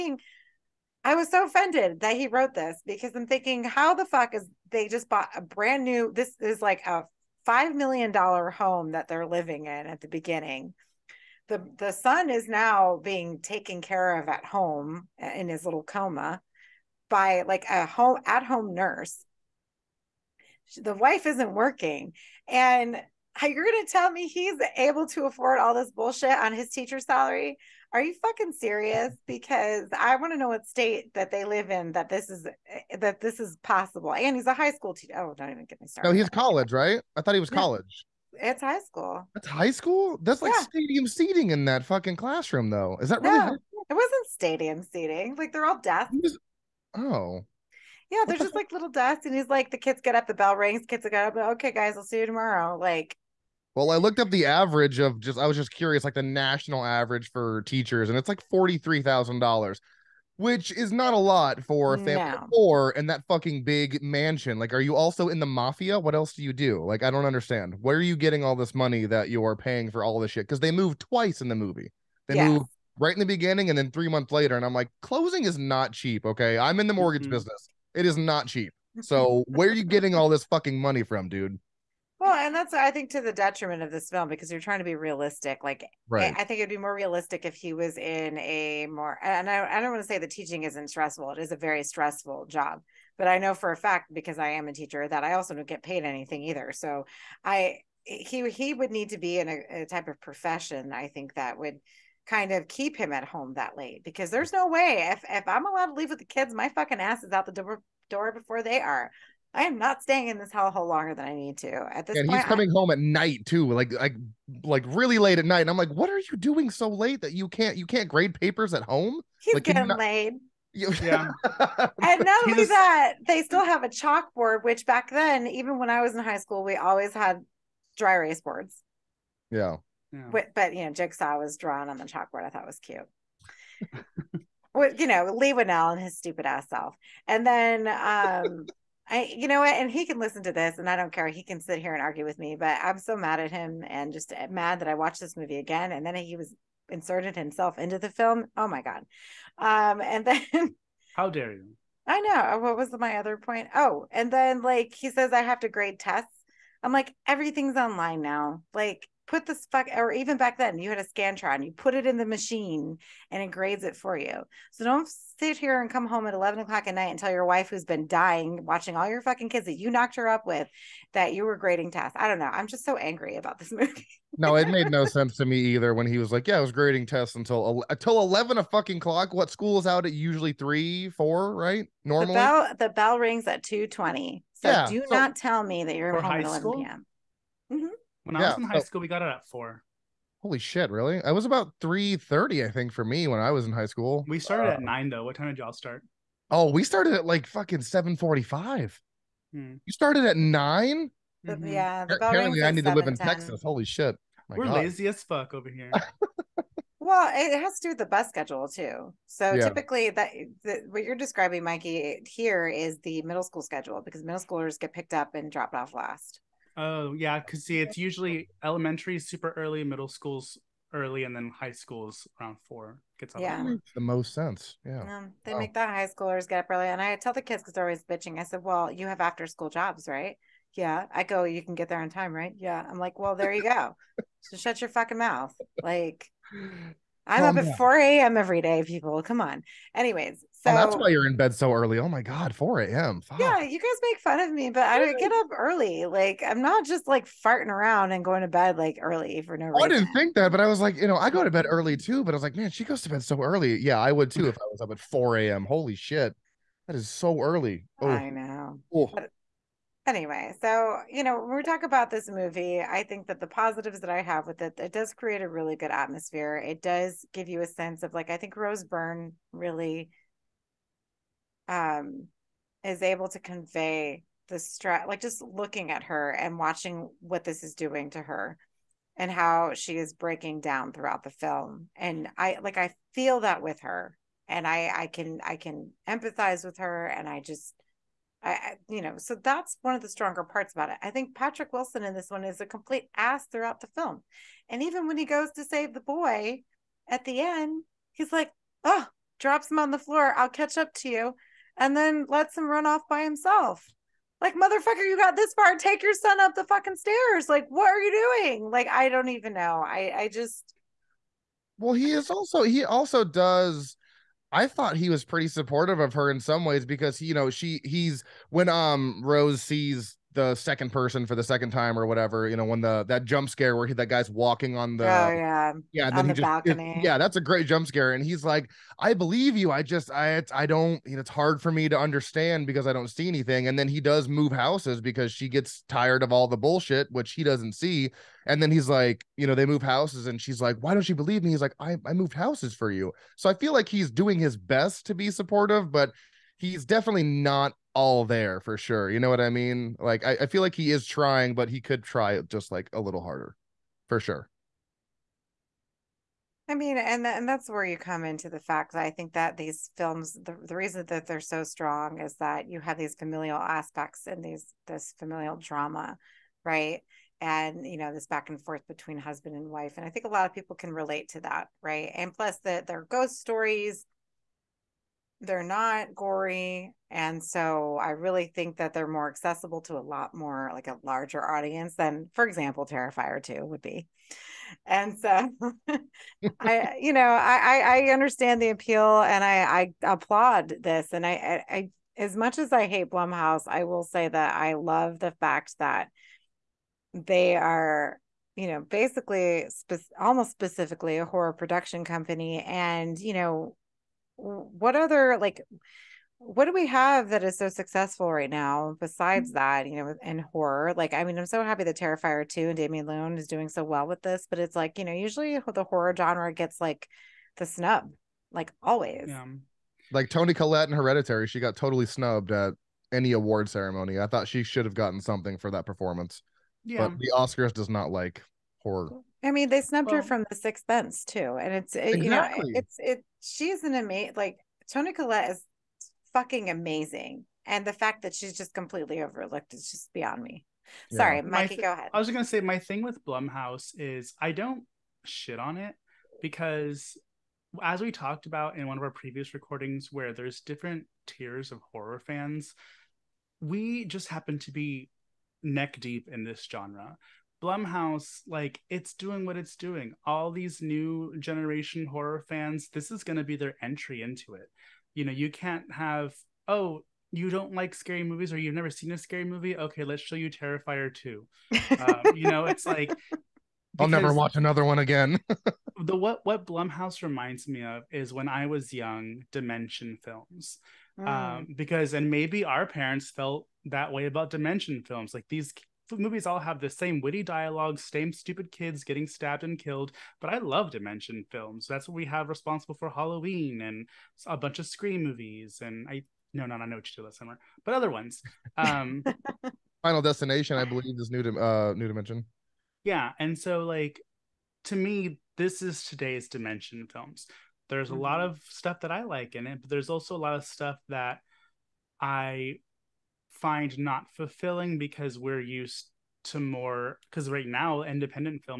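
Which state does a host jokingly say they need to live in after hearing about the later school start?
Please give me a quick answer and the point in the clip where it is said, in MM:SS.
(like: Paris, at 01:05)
Texas, at 03:23.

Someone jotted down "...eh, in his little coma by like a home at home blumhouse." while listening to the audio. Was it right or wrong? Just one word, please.
wrong.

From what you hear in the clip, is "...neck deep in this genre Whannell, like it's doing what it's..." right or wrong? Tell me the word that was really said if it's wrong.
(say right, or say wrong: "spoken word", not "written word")
wrong: "Blumhouse", not "Whannell".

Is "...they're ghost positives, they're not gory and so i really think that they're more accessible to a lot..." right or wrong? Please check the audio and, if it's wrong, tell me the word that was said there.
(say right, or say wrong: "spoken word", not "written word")
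wrong: "stories", not "positives".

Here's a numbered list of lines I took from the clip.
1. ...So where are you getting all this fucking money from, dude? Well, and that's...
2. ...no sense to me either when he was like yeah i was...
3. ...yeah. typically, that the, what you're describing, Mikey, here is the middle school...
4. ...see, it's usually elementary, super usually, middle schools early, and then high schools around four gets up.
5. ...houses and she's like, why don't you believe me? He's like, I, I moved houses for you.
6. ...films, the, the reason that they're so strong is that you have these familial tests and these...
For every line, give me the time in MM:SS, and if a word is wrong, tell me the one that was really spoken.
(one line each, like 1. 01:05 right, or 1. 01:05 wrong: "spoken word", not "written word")
1. 01:19 right
2. 02:54 right
3. 03:29 right
4. 03:37 wrong: "early", not "usually"
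5. 05:39 right
6. 05:59 wrong: "aspects", not "tests".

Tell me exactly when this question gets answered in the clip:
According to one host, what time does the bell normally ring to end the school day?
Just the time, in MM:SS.
03:03.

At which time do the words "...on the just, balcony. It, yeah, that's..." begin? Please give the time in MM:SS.
05:26.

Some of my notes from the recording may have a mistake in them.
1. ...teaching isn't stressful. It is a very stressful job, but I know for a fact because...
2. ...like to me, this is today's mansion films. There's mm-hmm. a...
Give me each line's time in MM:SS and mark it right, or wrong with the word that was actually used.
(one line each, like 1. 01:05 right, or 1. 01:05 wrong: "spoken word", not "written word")
1. 01:30 right
2. 08:23 wrong: "dimension", not "mansion".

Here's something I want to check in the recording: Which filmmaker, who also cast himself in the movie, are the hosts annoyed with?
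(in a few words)
Leigh Whannell.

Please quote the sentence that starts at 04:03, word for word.
Yeah, you guys make fun of me, but I don't get up early.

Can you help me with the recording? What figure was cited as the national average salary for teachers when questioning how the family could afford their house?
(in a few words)
$43,000.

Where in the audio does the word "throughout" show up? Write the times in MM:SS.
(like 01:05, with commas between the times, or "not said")
04:40, 04:53.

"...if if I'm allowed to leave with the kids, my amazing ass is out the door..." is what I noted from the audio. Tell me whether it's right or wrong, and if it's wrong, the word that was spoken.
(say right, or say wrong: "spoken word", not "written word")
wrong: "fucking", not "amazing".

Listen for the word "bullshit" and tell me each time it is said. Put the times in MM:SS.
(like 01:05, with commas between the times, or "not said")
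00:25, 05:36.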